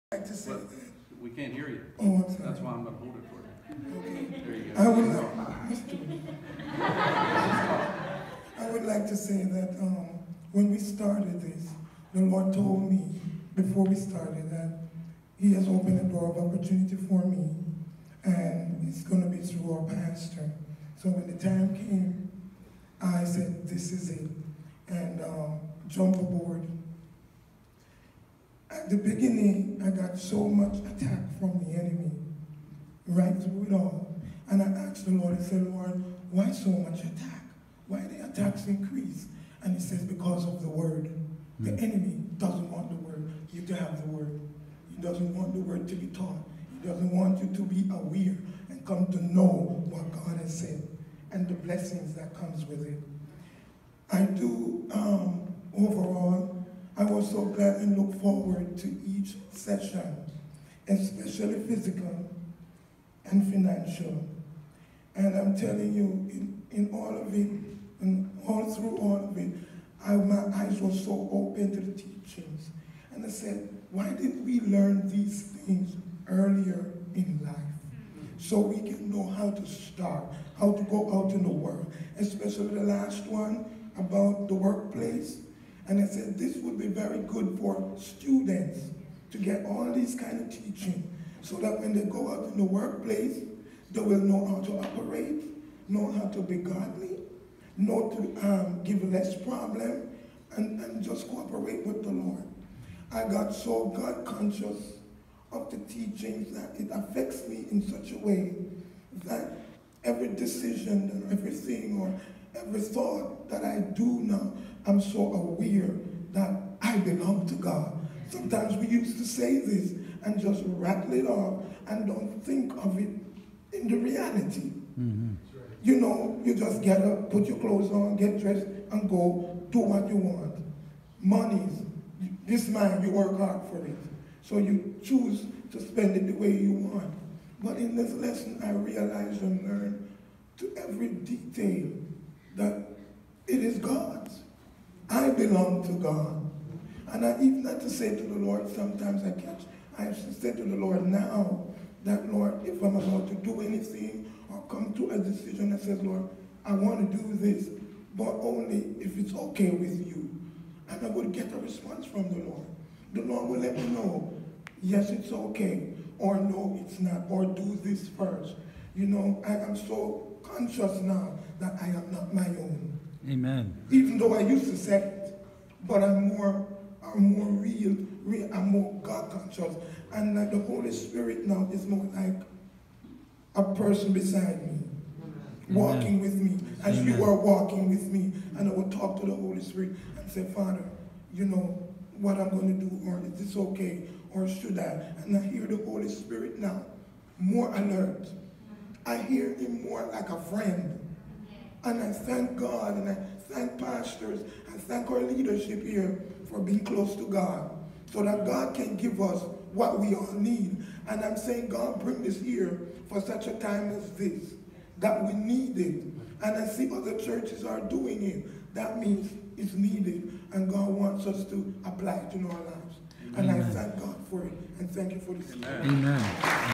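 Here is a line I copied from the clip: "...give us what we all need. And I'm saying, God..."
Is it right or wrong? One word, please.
right.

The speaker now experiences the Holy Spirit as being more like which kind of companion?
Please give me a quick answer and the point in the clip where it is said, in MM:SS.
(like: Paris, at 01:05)
A friend, at 03:20.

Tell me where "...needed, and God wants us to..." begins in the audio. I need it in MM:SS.
03:39.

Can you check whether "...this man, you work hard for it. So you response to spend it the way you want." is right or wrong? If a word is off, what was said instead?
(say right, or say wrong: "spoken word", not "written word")
wrong: "choose", not "response".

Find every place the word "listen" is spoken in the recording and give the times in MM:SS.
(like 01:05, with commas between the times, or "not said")
not said.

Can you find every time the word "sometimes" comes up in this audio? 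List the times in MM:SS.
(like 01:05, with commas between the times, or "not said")
01:58, 02:28.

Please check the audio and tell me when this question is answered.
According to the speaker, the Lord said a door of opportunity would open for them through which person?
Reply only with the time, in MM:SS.
00:19.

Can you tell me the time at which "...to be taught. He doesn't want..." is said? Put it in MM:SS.
00:45.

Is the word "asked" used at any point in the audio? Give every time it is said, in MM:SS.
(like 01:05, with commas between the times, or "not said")
00:34.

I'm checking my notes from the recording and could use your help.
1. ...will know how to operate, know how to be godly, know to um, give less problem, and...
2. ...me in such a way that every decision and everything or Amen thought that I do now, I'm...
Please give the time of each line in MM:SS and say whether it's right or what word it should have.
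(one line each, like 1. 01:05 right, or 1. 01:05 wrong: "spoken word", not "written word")
1. 01:33 right
2. 01:47 wrong: "Every", not "Amen".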